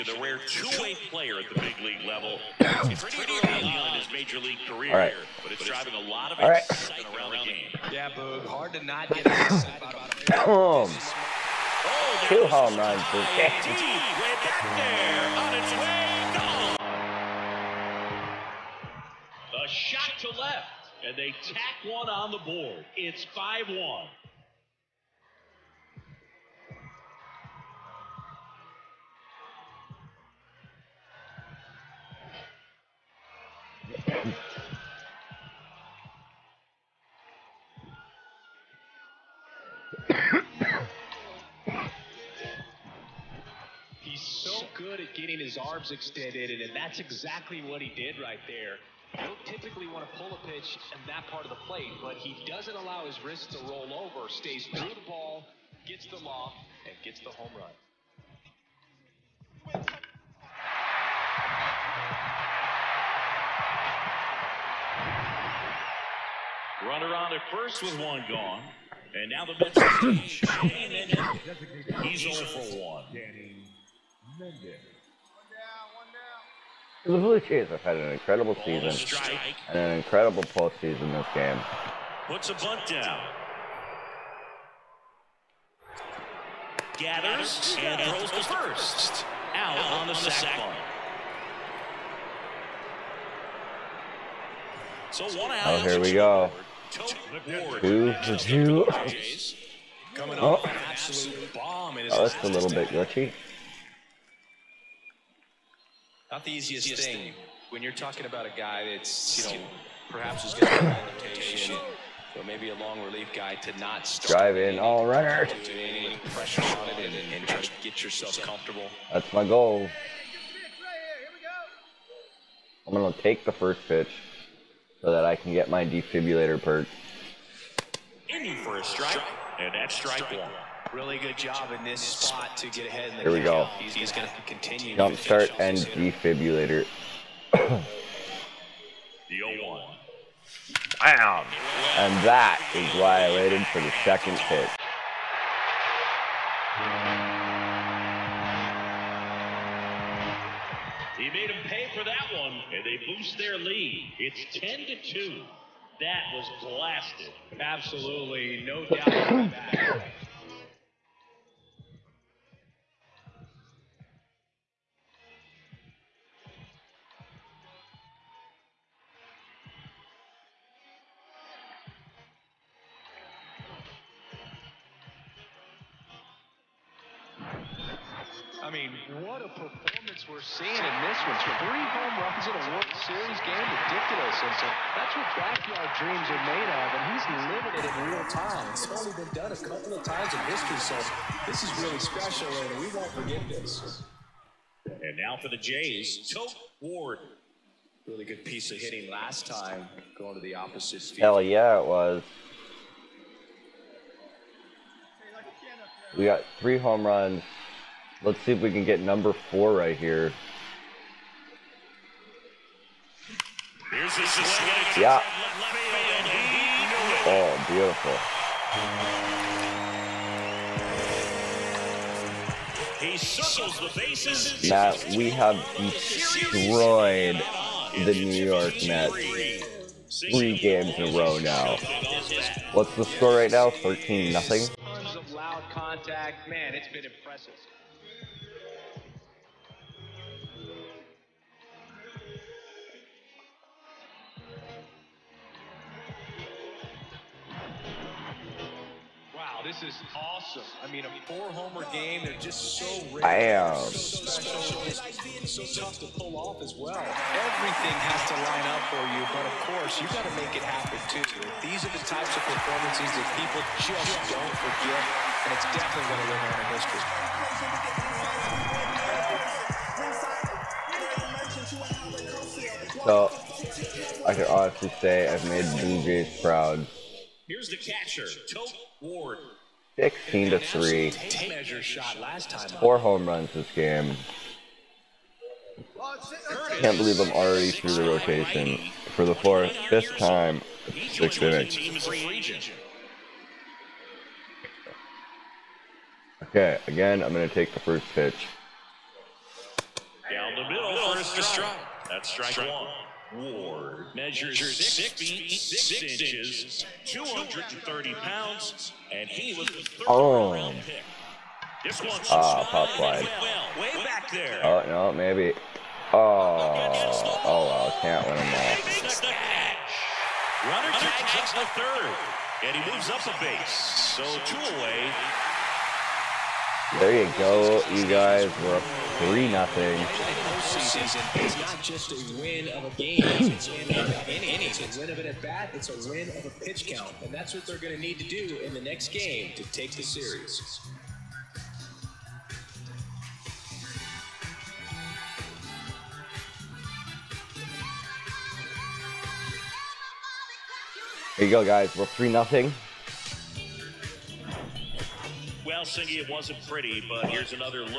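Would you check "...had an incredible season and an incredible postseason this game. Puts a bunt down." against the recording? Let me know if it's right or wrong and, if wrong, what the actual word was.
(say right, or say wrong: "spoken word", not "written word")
right.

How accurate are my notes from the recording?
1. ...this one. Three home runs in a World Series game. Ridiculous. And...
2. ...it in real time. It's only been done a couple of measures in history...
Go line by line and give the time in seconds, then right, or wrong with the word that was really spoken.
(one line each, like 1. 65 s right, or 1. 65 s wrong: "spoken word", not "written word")
1. 181 s right
2. 187 s wrong: "times", not "measures".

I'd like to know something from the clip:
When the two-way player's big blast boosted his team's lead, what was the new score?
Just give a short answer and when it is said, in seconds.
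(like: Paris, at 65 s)
10 to 2, at 154 s.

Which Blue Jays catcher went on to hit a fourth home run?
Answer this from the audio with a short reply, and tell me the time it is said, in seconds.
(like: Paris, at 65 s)
Tote Ward, at 196 s.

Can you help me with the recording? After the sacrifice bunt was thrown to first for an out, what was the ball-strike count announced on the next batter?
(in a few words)
2-2.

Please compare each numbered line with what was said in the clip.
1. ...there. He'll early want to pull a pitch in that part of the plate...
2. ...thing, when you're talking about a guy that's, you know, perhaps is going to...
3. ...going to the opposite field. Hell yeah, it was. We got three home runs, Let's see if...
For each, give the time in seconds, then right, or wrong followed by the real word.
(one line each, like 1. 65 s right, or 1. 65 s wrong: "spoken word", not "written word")
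1. 48 s wrong: "typically", not "early"
2. 107 s right
3. 200 s right.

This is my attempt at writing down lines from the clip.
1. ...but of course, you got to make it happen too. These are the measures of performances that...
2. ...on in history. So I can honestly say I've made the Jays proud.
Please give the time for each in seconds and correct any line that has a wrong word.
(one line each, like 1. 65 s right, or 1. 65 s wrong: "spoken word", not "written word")
1. 259 s wrong: "types", not "measures"
2. 273 s right.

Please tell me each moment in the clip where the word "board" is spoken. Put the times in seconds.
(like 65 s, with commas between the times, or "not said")
22 s.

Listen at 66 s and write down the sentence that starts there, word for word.
Runner on at first with one gone.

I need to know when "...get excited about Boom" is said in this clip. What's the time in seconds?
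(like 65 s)
9 s.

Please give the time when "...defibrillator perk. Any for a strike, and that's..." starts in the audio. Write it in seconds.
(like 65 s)
125 s.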